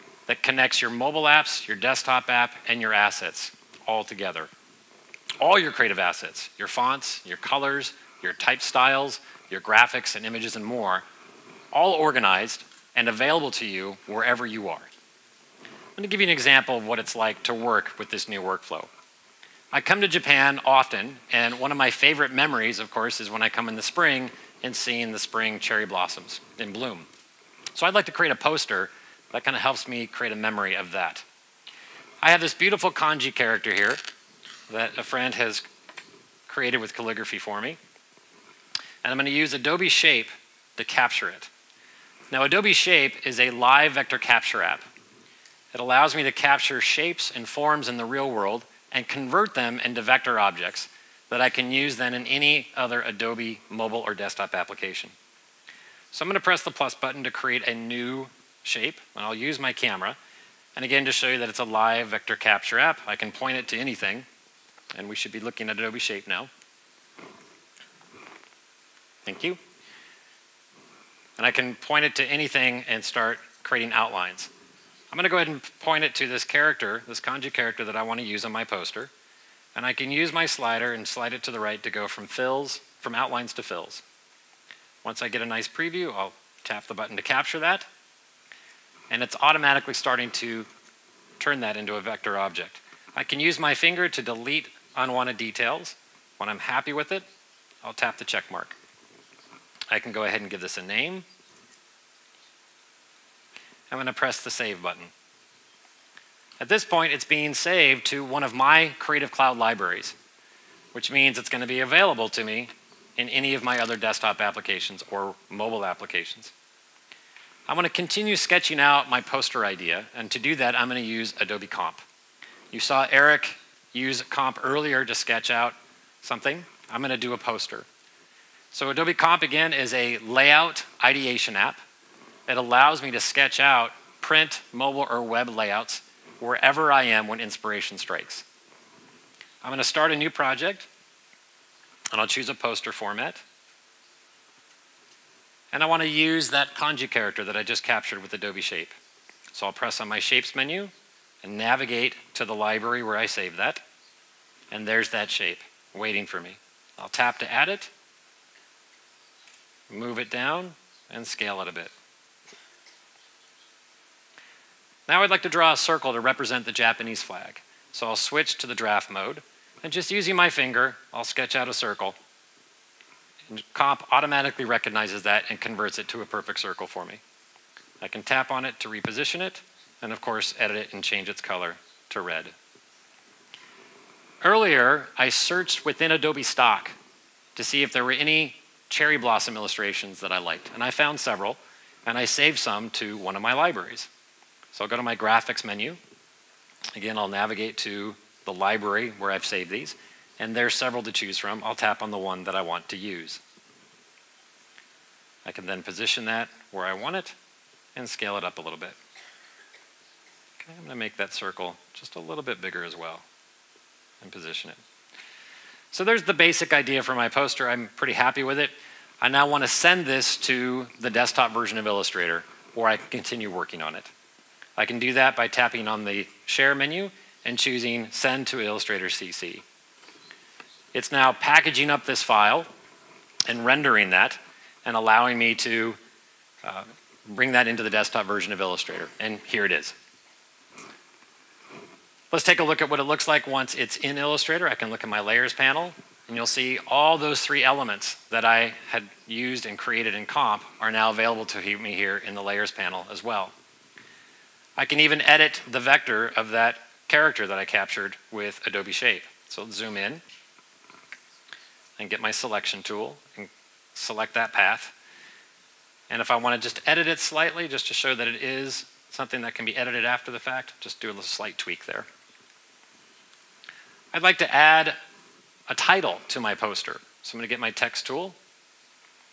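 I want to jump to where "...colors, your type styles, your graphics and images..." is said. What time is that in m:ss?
0:07.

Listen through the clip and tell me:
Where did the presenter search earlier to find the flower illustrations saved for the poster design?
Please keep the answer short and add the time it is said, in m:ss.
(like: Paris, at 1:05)
Adobe Stock, at 3:06.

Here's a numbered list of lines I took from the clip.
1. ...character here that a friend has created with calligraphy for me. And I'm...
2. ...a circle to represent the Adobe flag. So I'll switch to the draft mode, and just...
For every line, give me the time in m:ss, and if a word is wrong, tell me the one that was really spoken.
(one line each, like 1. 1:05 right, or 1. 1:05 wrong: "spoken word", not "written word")
1. 0:33 right
2. 2:45 wrong: "Japanese", not "Adobe".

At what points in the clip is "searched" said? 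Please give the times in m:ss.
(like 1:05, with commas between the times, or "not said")
3:05.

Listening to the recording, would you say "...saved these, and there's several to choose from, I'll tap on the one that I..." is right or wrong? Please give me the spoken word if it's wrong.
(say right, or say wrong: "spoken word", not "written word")
right.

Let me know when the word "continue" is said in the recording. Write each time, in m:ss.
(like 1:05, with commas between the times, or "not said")
1:57, 3:43.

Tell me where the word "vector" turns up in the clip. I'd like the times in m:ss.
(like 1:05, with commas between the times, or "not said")
0:43, 0:50, 1:02, 1:31, 4:15.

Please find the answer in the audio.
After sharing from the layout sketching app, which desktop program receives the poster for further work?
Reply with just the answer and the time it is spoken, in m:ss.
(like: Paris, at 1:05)
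Illustrator CC, at 3:48.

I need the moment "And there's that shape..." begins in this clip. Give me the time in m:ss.
2:34.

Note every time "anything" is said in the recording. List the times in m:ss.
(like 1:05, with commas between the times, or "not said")
1:03, 1:12.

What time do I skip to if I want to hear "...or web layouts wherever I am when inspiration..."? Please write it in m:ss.
2:15.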